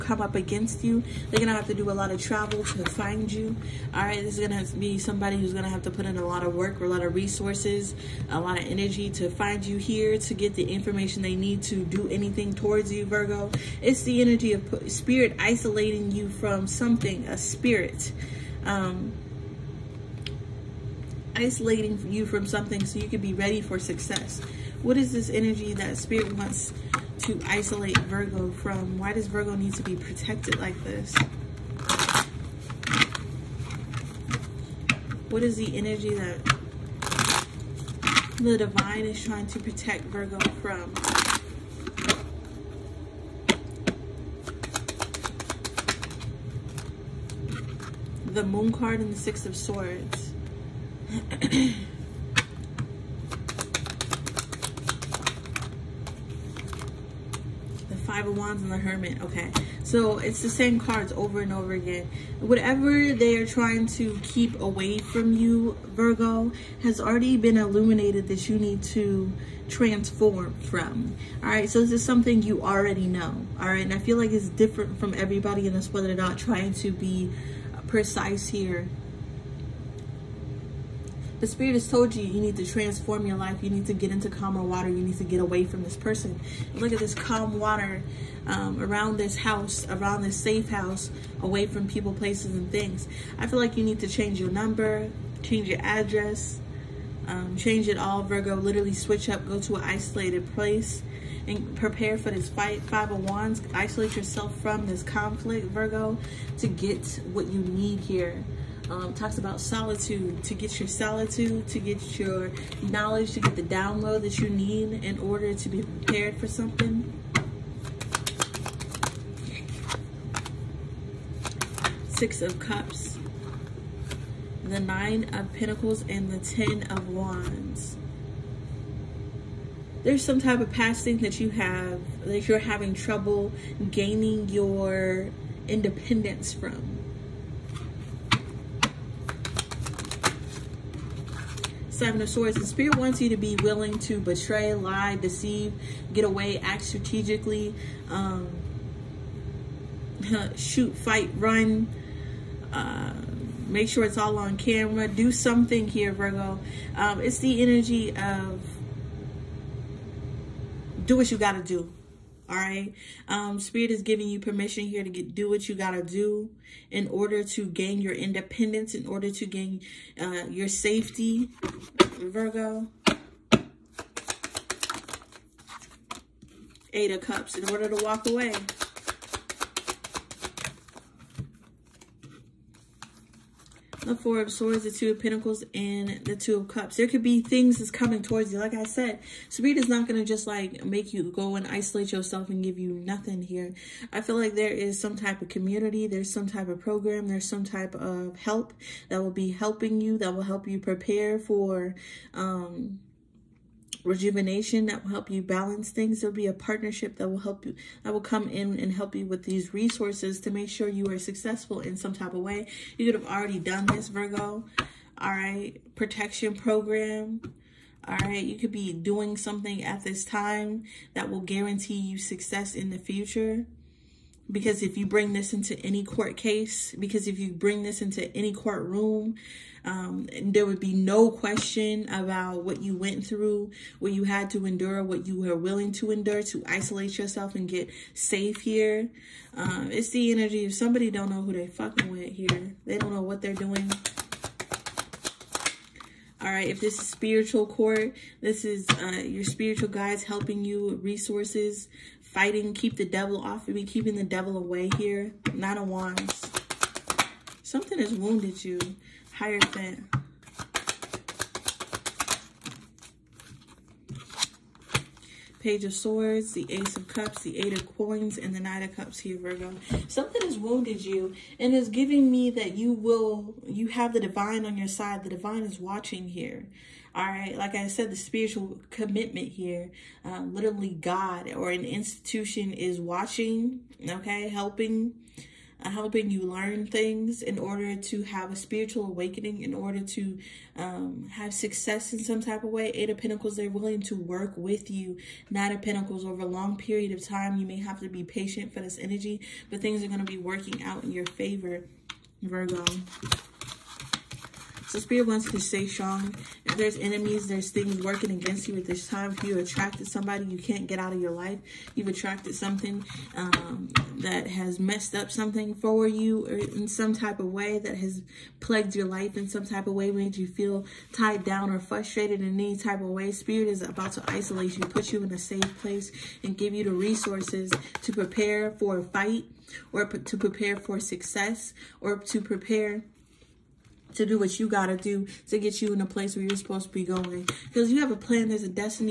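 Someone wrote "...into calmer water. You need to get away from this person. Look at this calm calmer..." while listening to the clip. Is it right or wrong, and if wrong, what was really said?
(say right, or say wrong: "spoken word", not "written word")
wrong: "water", not "calmer".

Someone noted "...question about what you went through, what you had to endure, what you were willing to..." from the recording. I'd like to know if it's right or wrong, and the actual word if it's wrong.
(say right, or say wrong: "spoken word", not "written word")
right.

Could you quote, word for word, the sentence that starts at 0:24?
What is this energy that spirit wants to isolate Virgo from?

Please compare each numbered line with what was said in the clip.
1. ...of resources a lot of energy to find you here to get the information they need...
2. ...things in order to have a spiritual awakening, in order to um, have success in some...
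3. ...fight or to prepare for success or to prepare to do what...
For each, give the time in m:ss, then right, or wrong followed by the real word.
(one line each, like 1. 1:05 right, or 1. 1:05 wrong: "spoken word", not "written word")
1. 0:07 right
2. 4:46 right
3. 5:29 right.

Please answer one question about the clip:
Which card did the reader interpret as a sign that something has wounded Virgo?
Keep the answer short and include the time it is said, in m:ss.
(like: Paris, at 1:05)
Nine of Wands, at 4:15.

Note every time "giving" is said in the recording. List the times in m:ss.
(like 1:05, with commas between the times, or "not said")
2:44, 4:31.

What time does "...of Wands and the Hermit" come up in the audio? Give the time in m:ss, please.
0:58.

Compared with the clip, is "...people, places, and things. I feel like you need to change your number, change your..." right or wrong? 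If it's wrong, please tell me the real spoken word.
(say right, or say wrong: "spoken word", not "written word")
right.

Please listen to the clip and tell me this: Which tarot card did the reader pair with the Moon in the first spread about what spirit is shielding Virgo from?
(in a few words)
Six of Swords.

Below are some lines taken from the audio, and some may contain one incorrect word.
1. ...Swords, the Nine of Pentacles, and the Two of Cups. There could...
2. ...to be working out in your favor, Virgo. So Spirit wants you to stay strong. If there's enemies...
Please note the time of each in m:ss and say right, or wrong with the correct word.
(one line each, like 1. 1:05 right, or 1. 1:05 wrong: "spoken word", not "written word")
1. 3:04 wrong: "Two", not "Nine"
2. 5:00 right.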